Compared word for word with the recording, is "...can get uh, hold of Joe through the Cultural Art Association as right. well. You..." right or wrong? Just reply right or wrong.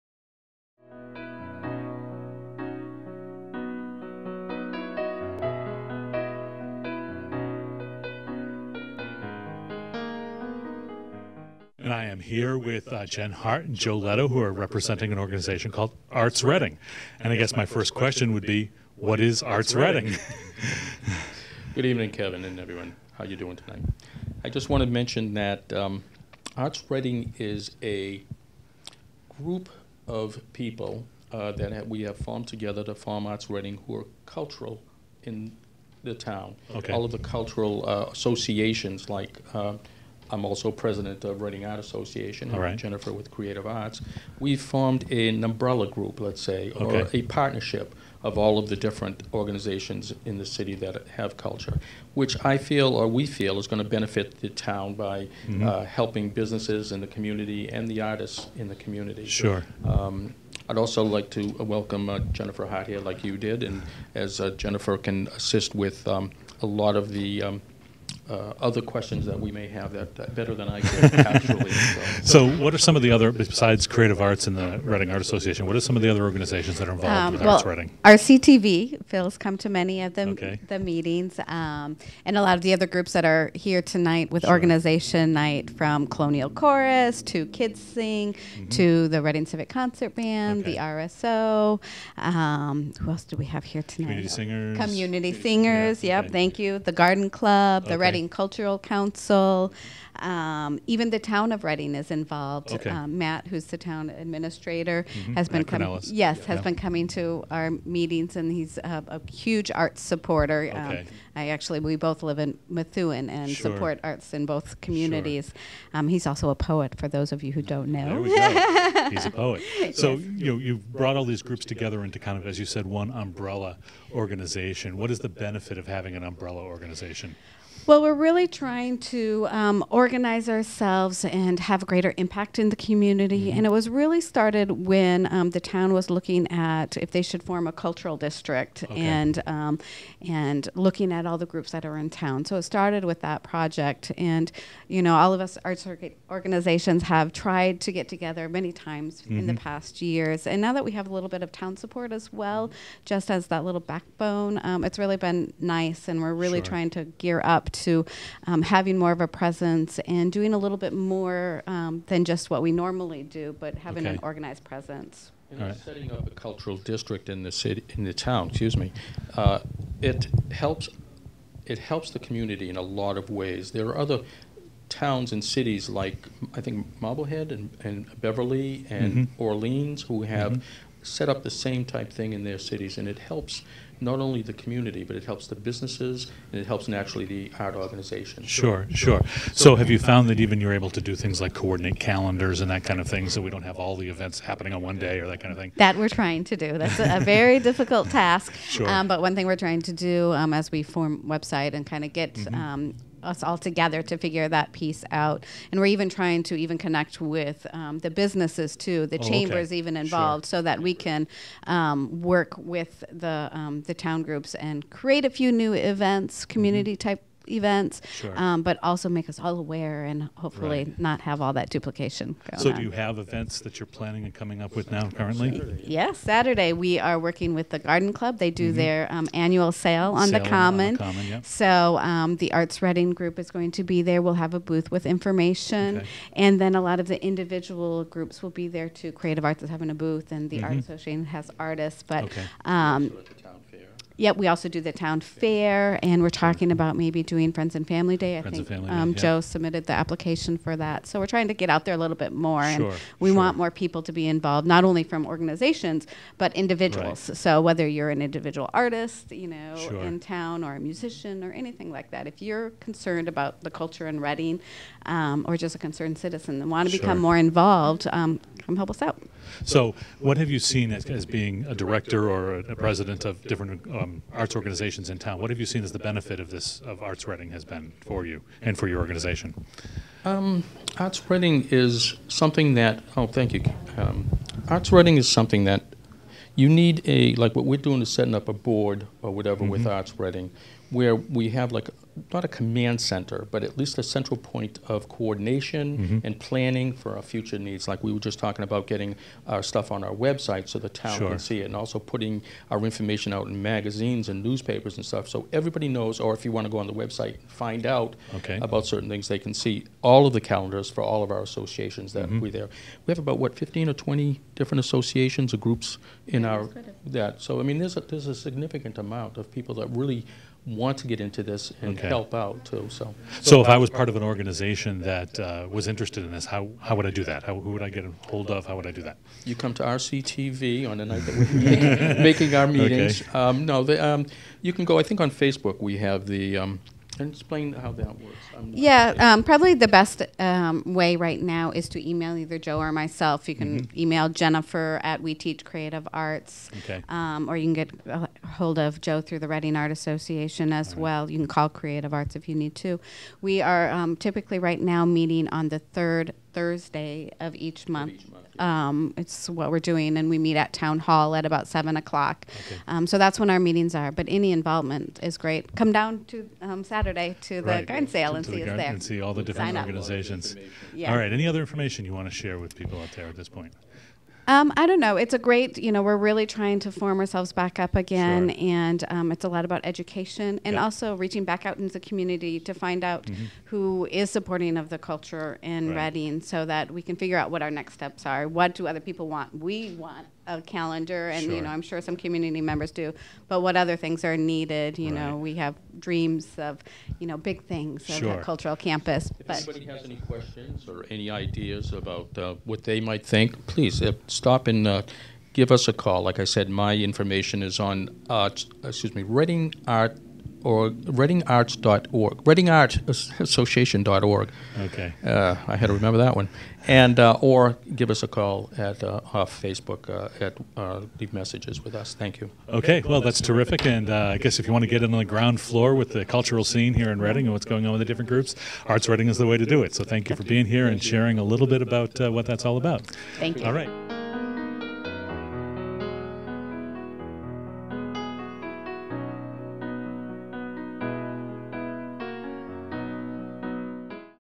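wrong.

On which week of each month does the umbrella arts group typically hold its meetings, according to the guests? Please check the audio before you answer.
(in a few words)
Third Thursday.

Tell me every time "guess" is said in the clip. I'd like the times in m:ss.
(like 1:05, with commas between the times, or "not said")
0:17, 7:04.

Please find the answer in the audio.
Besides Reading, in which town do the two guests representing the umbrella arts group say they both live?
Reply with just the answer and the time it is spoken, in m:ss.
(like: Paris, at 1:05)
Methuen, at 1:52.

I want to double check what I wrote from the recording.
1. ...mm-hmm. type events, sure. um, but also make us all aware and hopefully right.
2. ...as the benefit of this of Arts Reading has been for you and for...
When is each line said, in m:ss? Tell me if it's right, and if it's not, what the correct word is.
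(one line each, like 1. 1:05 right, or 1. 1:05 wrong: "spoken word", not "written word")
1. 3:36 right
2. 4:35 right.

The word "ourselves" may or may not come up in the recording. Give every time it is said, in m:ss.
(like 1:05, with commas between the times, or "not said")
2:10, 6:17.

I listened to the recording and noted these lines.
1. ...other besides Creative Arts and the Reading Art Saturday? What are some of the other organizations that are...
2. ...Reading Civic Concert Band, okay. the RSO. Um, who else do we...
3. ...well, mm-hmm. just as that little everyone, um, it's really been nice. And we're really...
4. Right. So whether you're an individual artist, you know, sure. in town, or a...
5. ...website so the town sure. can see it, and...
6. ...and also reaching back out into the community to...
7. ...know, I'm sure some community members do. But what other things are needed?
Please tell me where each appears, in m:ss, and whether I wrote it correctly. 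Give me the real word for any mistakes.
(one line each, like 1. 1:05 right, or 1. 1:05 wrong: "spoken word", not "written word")
1. 1:13 wrong: "Association", not "Saturday"
2. 1:29 right
3. 2:32 wrong: "backbone", not "everyone"
4. 4:17 right
5. 5:00 right
6. 6:20 right
7. 6:31 right.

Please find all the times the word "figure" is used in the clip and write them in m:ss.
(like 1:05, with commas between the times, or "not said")
3:24, 6:27.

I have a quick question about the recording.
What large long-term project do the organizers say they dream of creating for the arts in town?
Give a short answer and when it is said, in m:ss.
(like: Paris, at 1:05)
A cultural campus, at 6:38.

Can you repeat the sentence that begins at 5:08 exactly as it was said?
about certain things, they can see all of the calendars for all of our associations that mm -hmm.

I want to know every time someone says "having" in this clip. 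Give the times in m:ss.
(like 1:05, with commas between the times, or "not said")
2:05, 2:38, 2:43, 3:59.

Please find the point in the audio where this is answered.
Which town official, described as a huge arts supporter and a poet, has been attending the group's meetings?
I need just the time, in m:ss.
1:43.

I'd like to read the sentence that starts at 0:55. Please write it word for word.
uh, helping businesses in the community and the artists in the community.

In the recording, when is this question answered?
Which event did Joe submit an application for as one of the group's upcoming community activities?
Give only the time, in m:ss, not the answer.
4:07.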